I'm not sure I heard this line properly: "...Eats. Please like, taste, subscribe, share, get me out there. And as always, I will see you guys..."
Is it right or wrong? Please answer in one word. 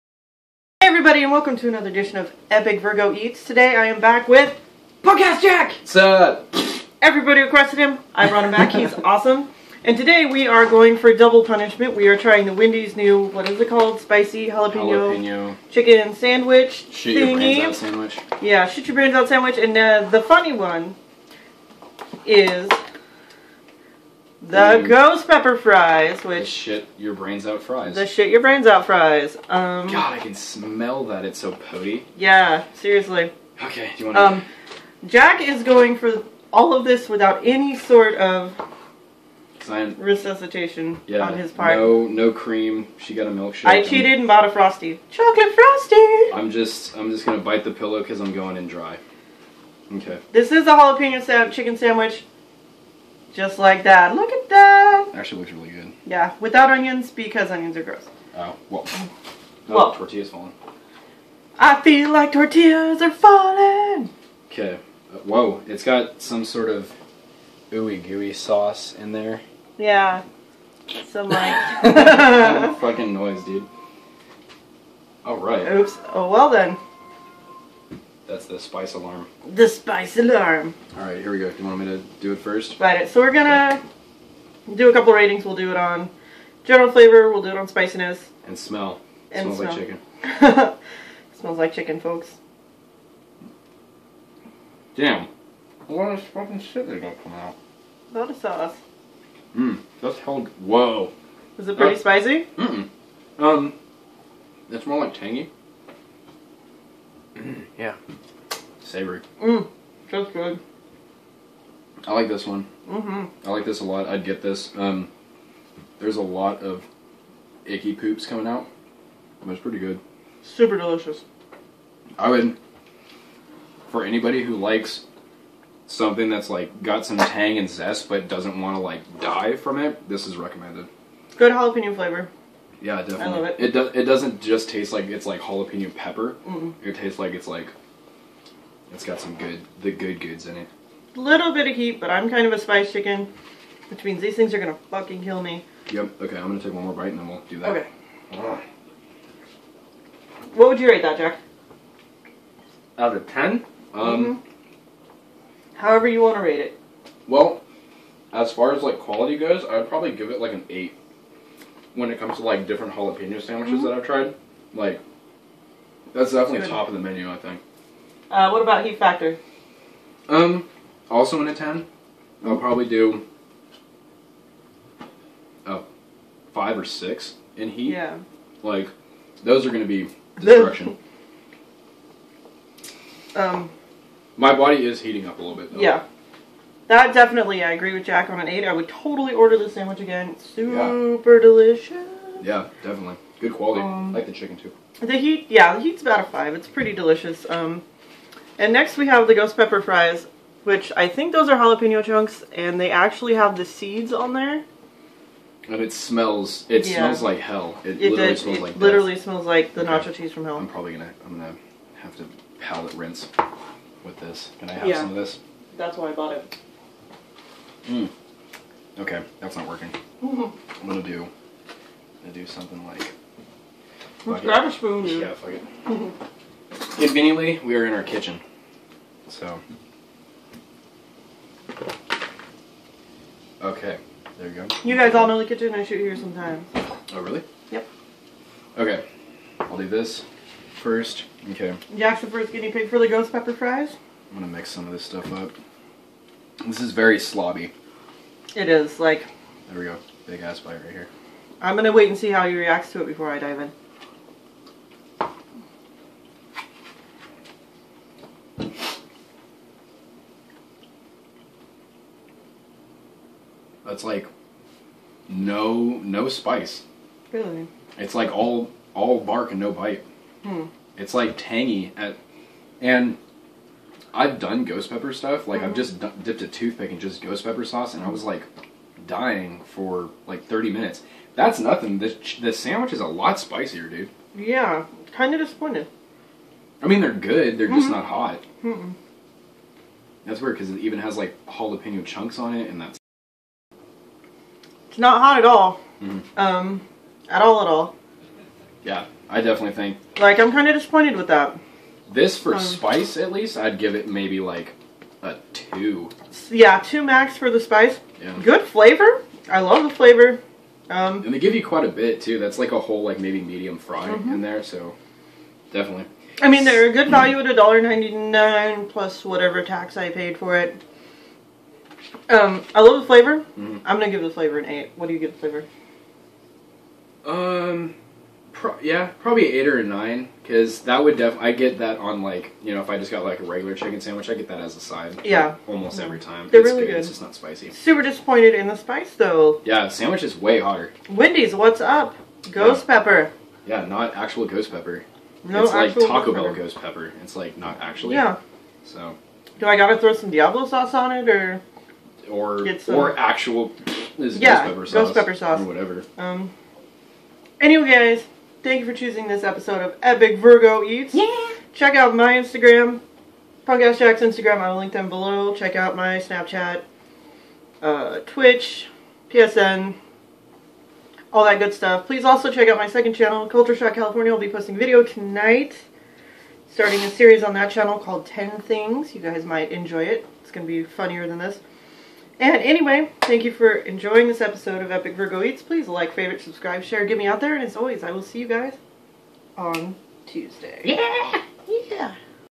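wrong.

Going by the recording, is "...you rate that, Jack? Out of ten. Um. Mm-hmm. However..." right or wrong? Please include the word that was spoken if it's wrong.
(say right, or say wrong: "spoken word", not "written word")
right.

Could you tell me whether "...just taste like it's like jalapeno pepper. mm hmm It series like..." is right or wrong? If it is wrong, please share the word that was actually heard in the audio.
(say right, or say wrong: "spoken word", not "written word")
wrong: "tastes", not "series".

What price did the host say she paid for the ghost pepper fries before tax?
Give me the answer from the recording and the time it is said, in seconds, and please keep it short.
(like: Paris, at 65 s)
$1.99, at 317 s.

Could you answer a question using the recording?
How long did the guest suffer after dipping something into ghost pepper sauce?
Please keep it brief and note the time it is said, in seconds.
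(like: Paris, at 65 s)
30 minutes, at 280 s.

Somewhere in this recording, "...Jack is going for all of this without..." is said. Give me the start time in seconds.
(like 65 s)
35 s.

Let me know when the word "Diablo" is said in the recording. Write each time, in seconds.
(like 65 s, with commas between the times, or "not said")
350 s.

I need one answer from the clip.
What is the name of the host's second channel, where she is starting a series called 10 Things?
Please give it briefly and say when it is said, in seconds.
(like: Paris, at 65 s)
Culture Shock California, at 373 s.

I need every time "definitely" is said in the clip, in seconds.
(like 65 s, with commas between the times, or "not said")
133 s, 166 s, 187 s, 192 s, 299 s, 315 s.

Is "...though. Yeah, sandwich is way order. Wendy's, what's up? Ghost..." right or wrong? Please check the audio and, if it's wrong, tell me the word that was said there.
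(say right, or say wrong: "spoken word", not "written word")
wrong: "hotter", not "order".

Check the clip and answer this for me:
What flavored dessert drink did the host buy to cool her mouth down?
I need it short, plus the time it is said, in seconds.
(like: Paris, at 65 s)
Chocolate Frosty, at 45 s.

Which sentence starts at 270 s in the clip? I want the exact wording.
It's like tangy at, and I've done ghost pepper stuff.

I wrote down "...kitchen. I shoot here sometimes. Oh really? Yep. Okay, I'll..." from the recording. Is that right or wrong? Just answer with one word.
right.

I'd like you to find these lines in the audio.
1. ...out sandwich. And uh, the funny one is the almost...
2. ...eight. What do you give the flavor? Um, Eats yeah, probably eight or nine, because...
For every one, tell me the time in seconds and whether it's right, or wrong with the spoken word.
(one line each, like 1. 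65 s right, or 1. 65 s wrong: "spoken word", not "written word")
1. 19 s wrong: "ghost", not "almost"
2. 324 s wrong: "Pro", not "Eats".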